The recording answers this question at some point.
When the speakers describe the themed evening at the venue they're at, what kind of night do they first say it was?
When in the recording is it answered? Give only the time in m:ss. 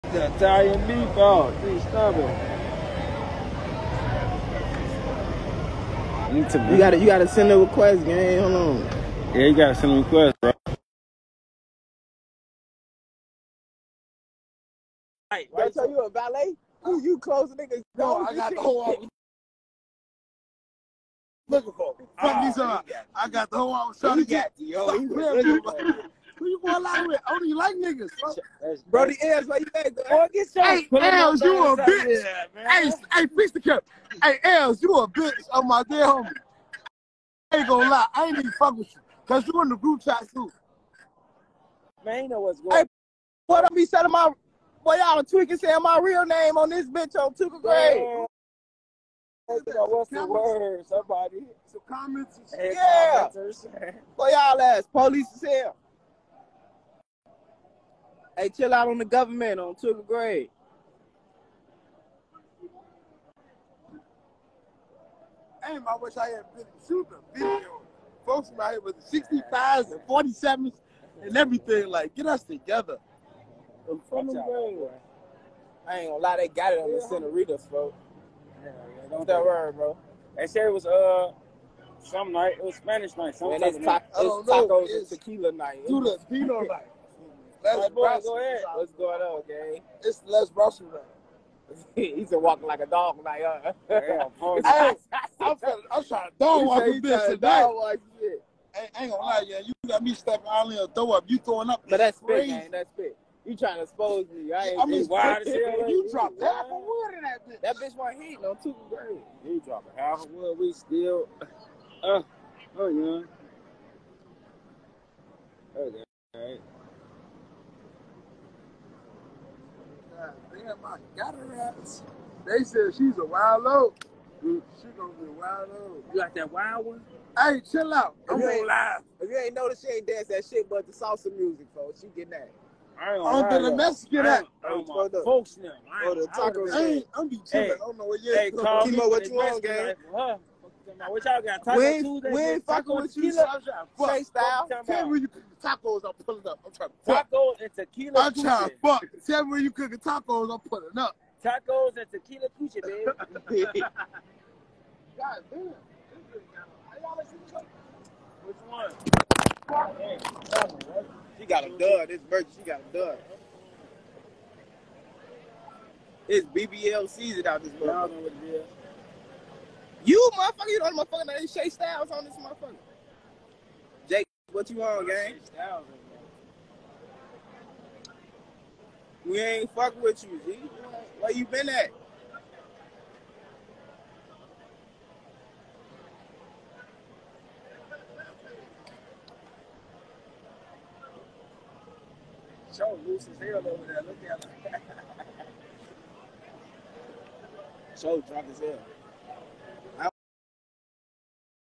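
1:22.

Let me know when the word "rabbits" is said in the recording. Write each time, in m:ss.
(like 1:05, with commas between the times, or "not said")
2:01.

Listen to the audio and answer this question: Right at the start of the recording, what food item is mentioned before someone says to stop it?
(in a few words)
Italian meatball.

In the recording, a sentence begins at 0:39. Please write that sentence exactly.
Because you in the group chat, too.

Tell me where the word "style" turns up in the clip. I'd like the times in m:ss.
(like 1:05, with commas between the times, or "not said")
2:24, 2:51.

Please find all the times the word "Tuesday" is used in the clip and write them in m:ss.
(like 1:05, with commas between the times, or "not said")
2:22, 2:28.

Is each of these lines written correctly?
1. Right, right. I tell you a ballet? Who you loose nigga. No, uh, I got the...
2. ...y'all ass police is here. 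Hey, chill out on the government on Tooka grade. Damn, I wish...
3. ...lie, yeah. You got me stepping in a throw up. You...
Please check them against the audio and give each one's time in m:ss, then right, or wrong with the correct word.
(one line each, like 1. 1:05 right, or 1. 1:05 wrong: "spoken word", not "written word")
1. 0:15 wrong: "close", not "loose"
2. 0:54 right
3. 1:39 right.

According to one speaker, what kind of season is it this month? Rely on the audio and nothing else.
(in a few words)
BBL season.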